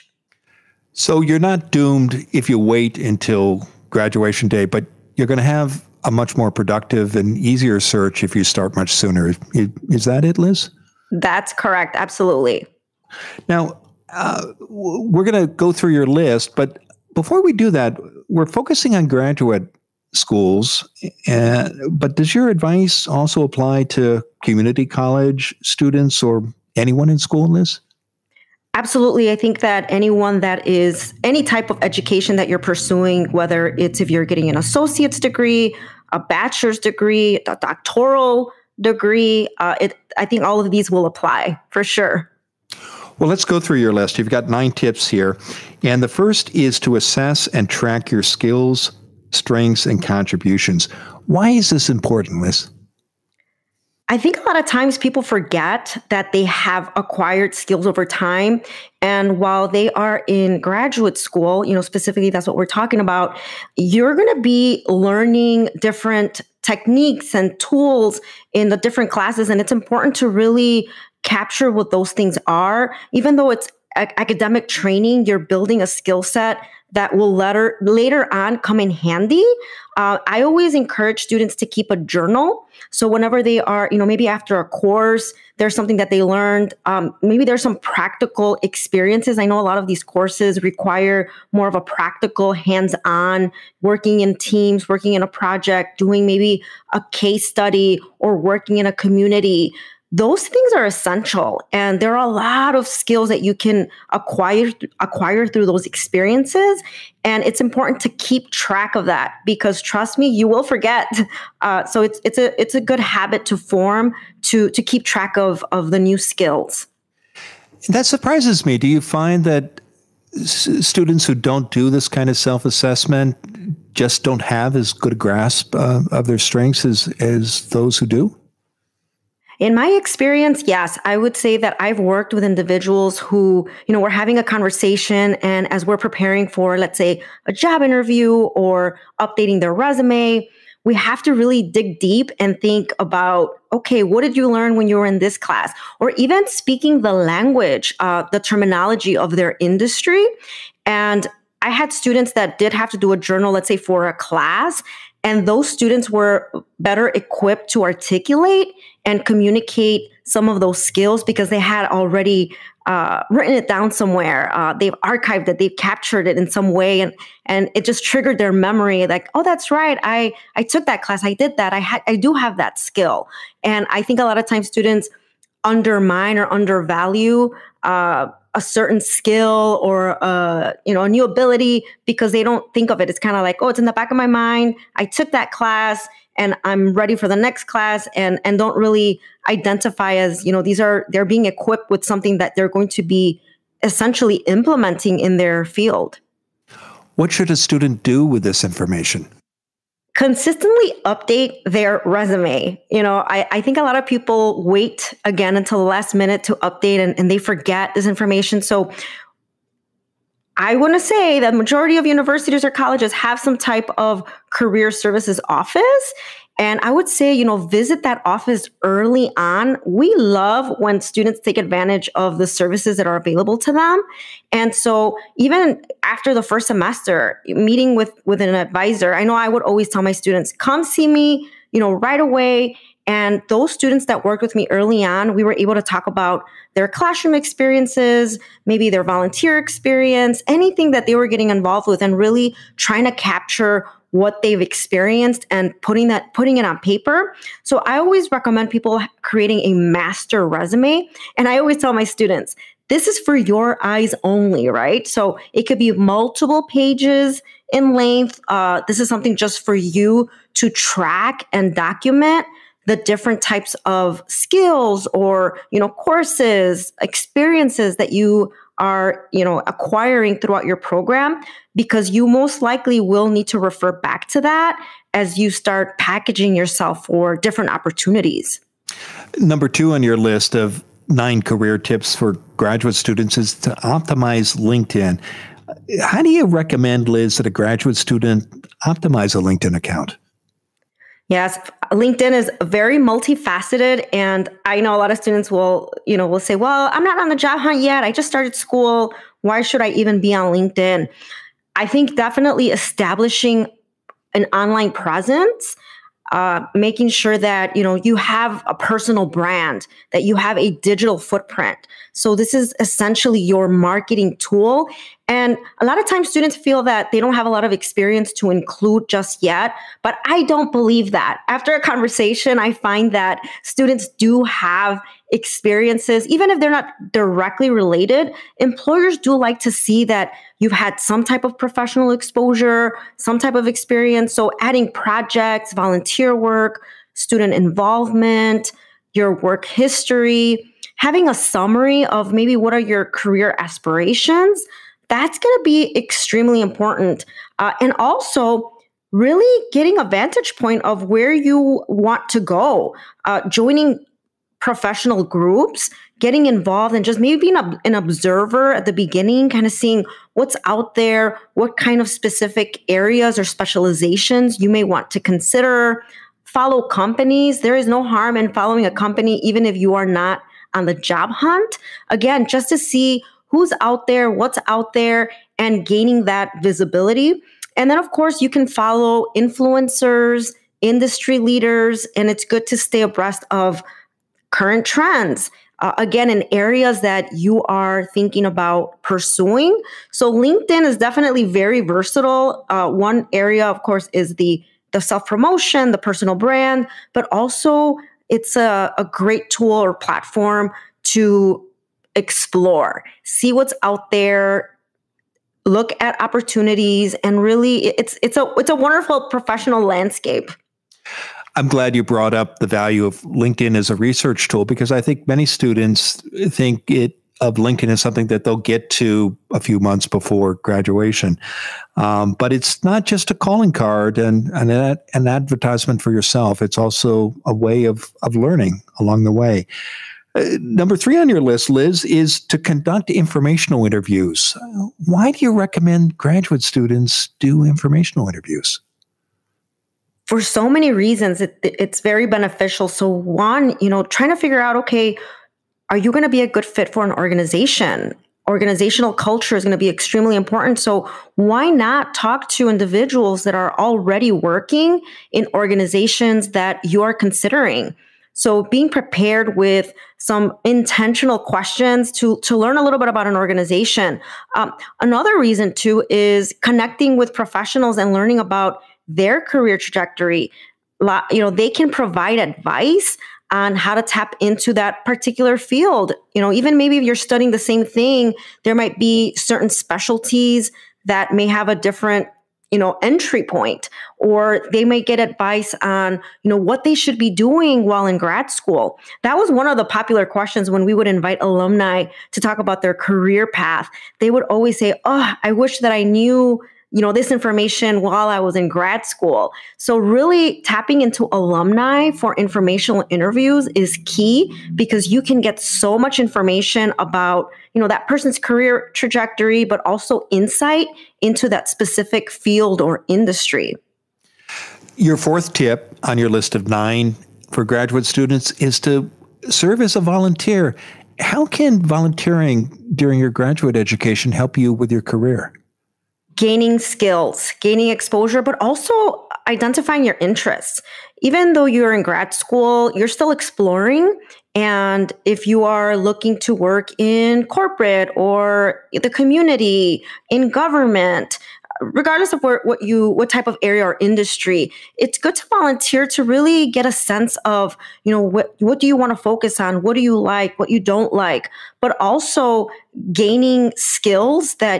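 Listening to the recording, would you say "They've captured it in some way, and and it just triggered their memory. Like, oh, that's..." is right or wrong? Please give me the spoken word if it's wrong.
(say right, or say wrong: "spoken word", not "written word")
right.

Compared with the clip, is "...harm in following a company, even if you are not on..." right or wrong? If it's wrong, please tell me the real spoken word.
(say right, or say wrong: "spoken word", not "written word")
right.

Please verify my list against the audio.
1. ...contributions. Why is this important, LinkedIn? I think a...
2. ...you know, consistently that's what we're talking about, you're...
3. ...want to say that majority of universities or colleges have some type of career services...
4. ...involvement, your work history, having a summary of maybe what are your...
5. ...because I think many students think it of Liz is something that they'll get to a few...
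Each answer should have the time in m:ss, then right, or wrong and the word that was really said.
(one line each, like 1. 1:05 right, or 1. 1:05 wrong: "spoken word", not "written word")
1. 0:50 wrong: "Liz", not "LinkedIn"
2. 1:01 wrong: "specifically", not "consistently"
3. 3:30 right
4. 5:37 right
5. 6:54 wrong: "LinkedIn", not "Liz".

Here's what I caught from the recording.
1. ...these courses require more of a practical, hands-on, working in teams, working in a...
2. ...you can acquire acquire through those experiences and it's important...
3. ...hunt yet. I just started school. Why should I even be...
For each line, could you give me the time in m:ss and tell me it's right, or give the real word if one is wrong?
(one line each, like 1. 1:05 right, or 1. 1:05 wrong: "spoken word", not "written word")
1. 1:29 right
2. 1:43 right
3. 4:57 right.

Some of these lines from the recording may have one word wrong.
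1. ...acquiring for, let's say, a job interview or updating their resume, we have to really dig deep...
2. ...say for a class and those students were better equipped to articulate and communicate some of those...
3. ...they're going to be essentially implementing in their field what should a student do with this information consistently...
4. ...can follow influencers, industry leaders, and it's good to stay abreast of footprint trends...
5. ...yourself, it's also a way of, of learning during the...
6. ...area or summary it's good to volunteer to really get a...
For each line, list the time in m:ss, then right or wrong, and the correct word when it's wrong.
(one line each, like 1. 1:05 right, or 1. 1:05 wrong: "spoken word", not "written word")
1. 2:15 wrong: "preparing", not "acquiring"
2. 2:33 right
3. 3:12 right
4. 6:18 wrong: "current", not "footprint"
5. 7:06 wrong: "along", not "during"
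6. 9:03 wrong: "industry", not "summary".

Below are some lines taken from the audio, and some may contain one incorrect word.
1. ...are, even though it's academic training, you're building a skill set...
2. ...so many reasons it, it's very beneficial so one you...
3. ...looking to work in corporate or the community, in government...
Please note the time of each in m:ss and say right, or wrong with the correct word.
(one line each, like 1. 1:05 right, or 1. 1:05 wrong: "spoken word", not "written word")
1. 1:12 right
2. 7:20 right
3. 8:55 right.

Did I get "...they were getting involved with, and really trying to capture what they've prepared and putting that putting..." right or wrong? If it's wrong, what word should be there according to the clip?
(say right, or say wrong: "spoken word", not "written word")
wrong: "experienced", not "prepared".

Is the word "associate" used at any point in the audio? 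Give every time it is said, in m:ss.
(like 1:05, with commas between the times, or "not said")
0:34.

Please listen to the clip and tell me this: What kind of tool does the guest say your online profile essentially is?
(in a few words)
Marketing tool.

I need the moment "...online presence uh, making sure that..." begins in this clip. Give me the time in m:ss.
5:04.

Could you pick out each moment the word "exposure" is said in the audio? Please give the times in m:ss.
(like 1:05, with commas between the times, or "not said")
5:32, 8:47.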